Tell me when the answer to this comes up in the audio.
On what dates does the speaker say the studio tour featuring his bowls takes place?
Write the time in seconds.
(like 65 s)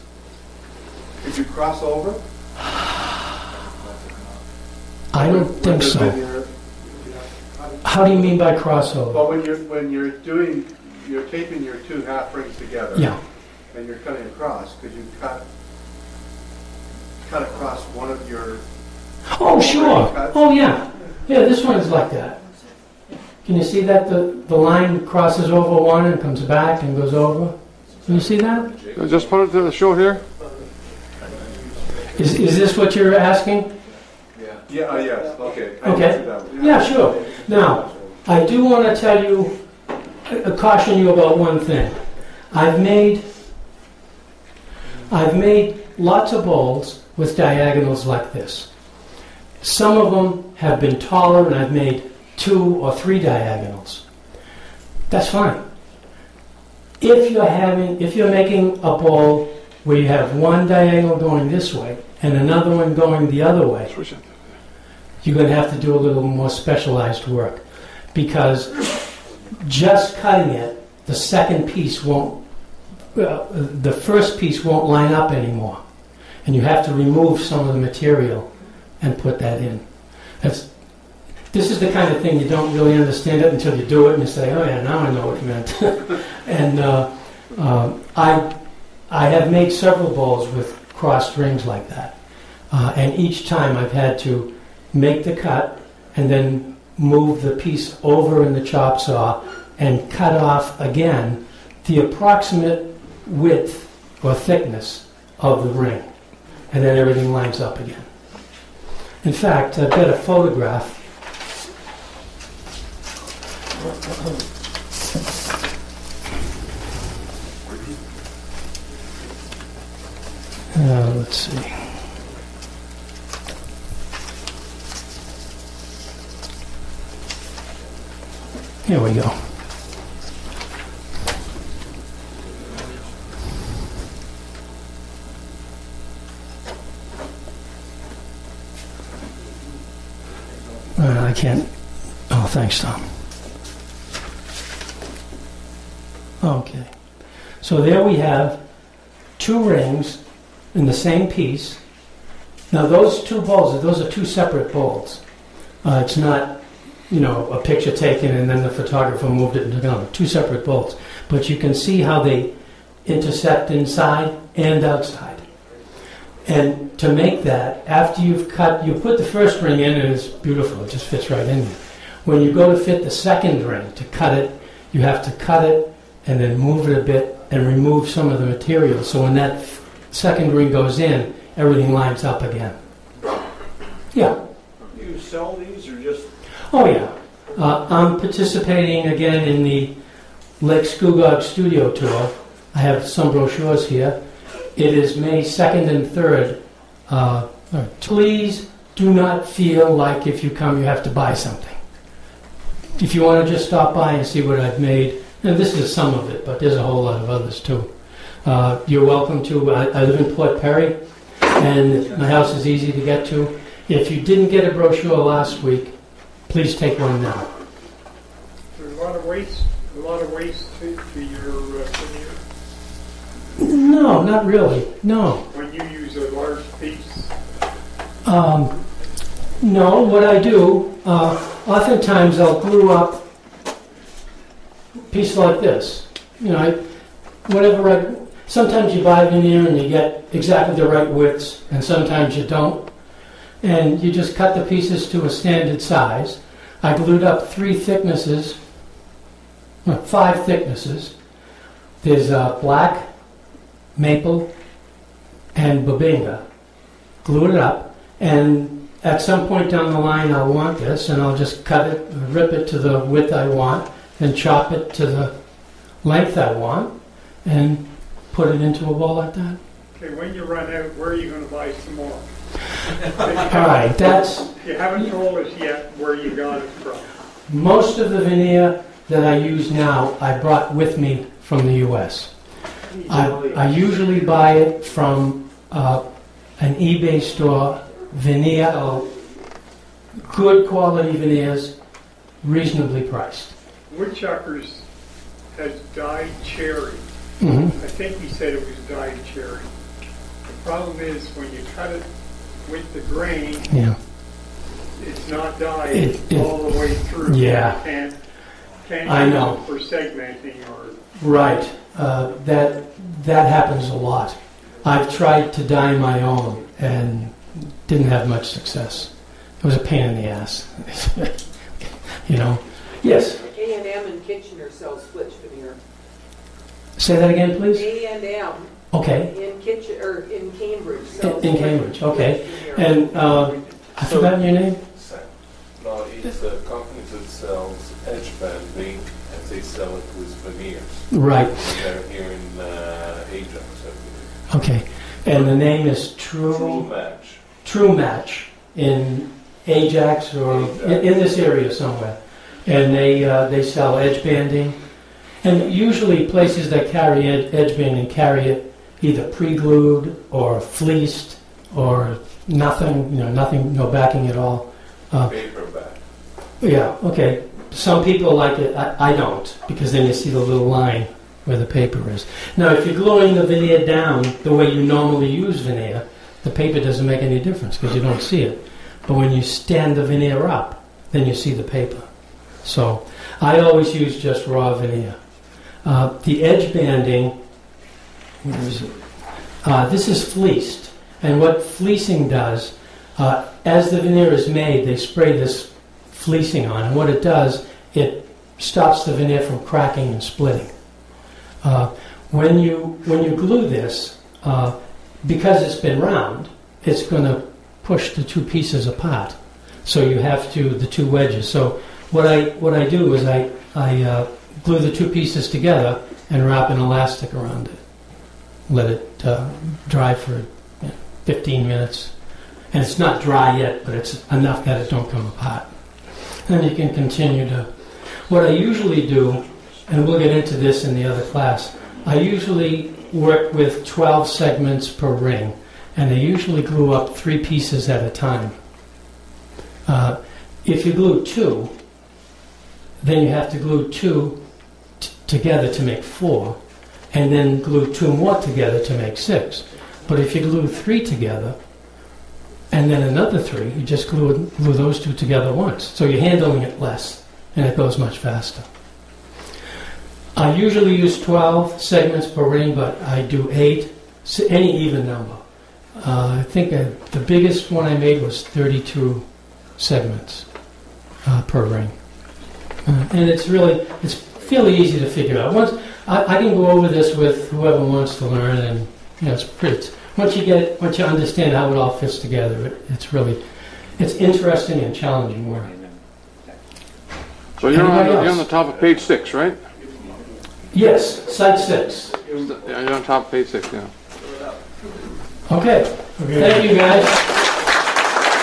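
195 s.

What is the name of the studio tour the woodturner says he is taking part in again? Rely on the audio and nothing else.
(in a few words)
Lake Scugog Studio Tour.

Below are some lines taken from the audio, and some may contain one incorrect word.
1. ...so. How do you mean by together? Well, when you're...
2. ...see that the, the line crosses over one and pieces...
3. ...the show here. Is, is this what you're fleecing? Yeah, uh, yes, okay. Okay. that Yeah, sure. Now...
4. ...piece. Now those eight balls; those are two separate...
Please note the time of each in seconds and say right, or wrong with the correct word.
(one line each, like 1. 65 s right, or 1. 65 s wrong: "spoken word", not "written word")
1. 5 s wrong: "crossover", not "together"
2. 23 s wrong: "comes", not "pieces"
3. 29 s wrong: "asking", not "fleecing"
4. 151 s wrong: "two", not "eight".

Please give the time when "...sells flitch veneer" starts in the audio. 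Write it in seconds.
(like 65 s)
324 s.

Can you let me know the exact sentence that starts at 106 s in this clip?
And then everything lines up again.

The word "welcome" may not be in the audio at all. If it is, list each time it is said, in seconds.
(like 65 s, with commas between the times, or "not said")
209 s.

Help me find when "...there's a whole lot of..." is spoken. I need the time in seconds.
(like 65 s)
206 s.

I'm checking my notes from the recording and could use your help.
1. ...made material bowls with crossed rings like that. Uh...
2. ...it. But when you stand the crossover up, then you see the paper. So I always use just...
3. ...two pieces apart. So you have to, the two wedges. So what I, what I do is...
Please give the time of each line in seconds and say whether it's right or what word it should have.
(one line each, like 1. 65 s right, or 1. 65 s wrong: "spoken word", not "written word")
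1. 89 s wrong: "several", not "material"
2. 378 s wrong: "veneer", not "crossover"
3. 408 s right.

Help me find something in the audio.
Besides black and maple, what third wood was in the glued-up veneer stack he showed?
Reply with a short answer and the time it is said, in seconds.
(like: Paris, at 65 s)
Bubinga, at 255 s.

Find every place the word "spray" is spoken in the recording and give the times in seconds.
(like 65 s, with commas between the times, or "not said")
394 s.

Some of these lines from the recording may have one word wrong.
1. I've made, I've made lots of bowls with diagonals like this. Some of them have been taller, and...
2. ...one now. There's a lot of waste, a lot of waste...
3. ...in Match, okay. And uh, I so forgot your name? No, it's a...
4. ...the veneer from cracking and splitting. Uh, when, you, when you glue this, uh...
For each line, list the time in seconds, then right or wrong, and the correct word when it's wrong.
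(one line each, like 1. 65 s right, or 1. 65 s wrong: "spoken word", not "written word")
1. 42 s right
2. 216 s right
3. 331 s wrong: "Cambridge", not "Match"
4. 399 s right.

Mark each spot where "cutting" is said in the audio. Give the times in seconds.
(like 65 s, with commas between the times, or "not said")
14 s, 70 s.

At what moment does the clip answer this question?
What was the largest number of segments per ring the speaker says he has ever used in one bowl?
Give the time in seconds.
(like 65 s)
468 s.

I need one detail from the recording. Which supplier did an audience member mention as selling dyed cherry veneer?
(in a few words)
Woodchuckers.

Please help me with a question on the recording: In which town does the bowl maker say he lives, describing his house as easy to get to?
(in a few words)
Port Perry.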